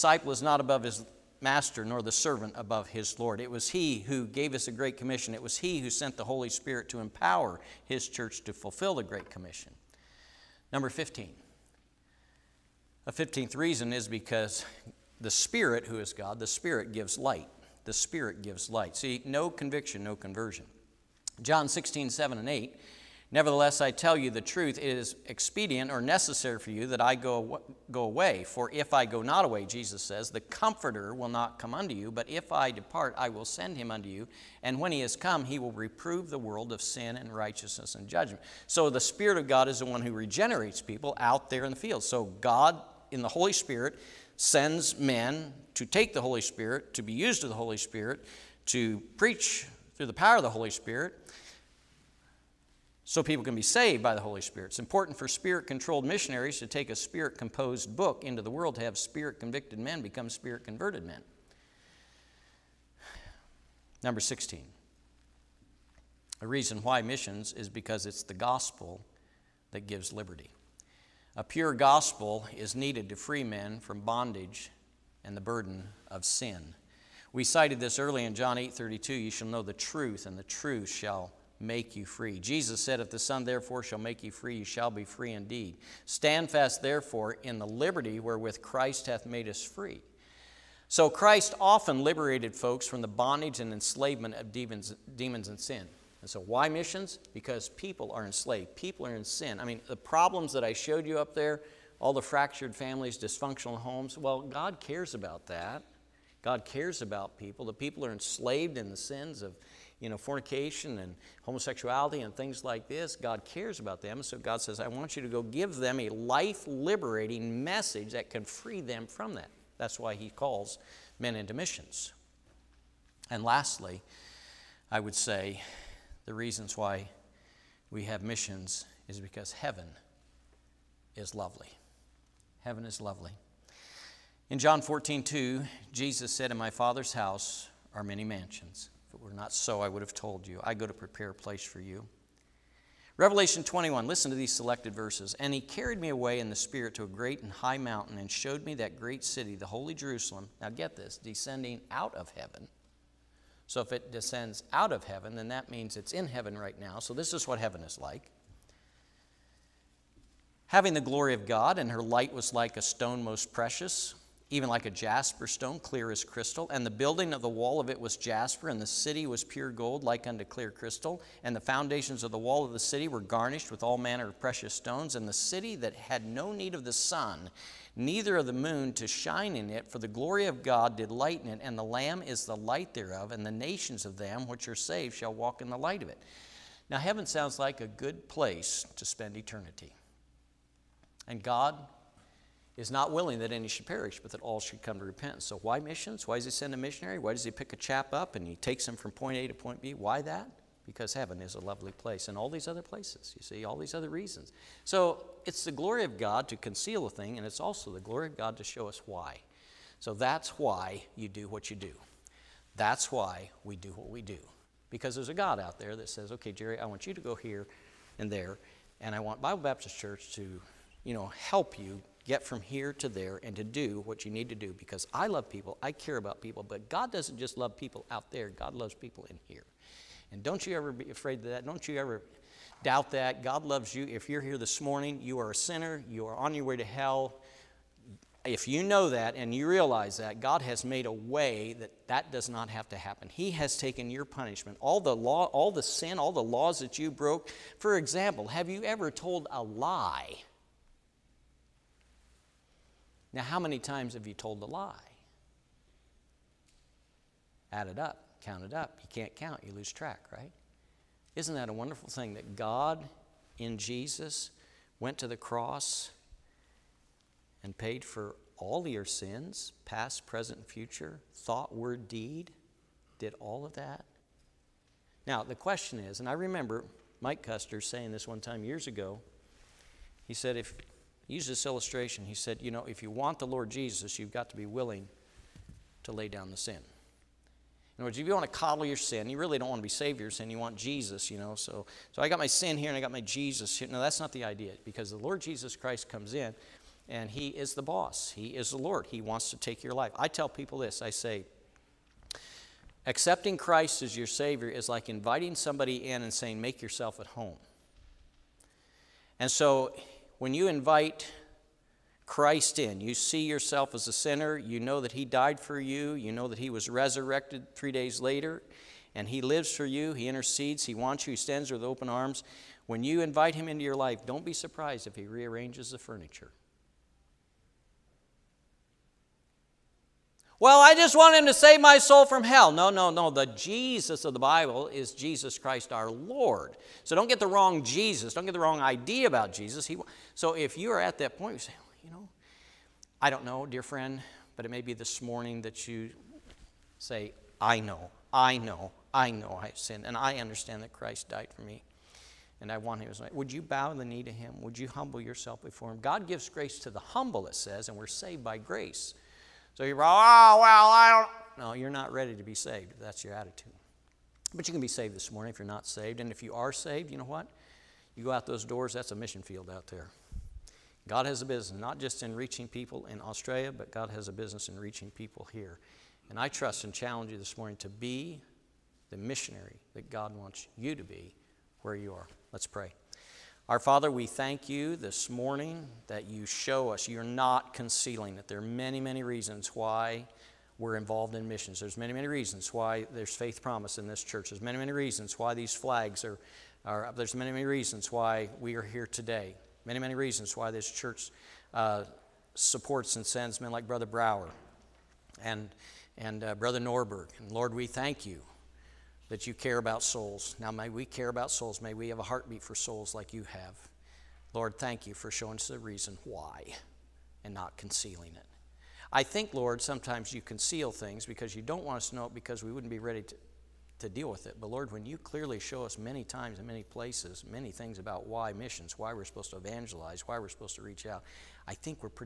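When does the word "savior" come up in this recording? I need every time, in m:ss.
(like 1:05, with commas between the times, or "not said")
4:49, 5:04.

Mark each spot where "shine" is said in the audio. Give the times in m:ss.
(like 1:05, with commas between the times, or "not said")
2:59.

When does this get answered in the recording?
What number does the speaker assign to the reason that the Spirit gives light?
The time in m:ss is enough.
0:10.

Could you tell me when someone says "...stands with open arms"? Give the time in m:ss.
5:21.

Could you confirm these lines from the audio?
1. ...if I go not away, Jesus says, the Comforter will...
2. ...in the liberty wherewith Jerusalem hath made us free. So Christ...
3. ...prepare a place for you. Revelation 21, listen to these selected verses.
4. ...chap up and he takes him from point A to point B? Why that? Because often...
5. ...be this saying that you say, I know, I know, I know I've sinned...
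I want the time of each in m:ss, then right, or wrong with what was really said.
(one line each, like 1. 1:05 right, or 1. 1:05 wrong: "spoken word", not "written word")
1. 0:28 right
2. 1:27 wrong: "Christ", not "Jerusalem"
3. 2:20 right
4. 3:17 wrong: "heaven", not "often"
5. 5:44 wrong: "morning", not "saying".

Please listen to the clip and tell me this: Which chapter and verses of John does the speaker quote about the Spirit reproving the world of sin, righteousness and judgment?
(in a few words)
John 16:7-8.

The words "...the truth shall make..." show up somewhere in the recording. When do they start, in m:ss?
1:20.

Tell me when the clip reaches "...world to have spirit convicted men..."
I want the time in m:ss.
0:58.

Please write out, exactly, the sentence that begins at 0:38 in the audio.
So the Spirit of God is the one who regenerates people out there in the field.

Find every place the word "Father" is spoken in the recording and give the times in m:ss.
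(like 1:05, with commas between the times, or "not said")
2:16, 6:23.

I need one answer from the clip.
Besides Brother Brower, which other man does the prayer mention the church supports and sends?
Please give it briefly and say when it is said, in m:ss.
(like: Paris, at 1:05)
Brother Norberg, at 6:46.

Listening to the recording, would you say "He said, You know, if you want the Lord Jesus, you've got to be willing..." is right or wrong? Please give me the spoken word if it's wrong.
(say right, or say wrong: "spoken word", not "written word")
right.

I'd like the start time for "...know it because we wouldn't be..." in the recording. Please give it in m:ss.
7:02.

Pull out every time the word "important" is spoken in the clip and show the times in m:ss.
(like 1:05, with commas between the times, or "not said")
0:54.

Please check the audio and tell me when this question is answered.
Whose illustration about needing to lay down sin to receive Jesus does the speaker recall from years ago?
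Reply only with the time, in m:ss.
4:37.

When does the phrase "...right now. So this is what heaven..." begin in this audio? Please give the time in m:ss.
2:36.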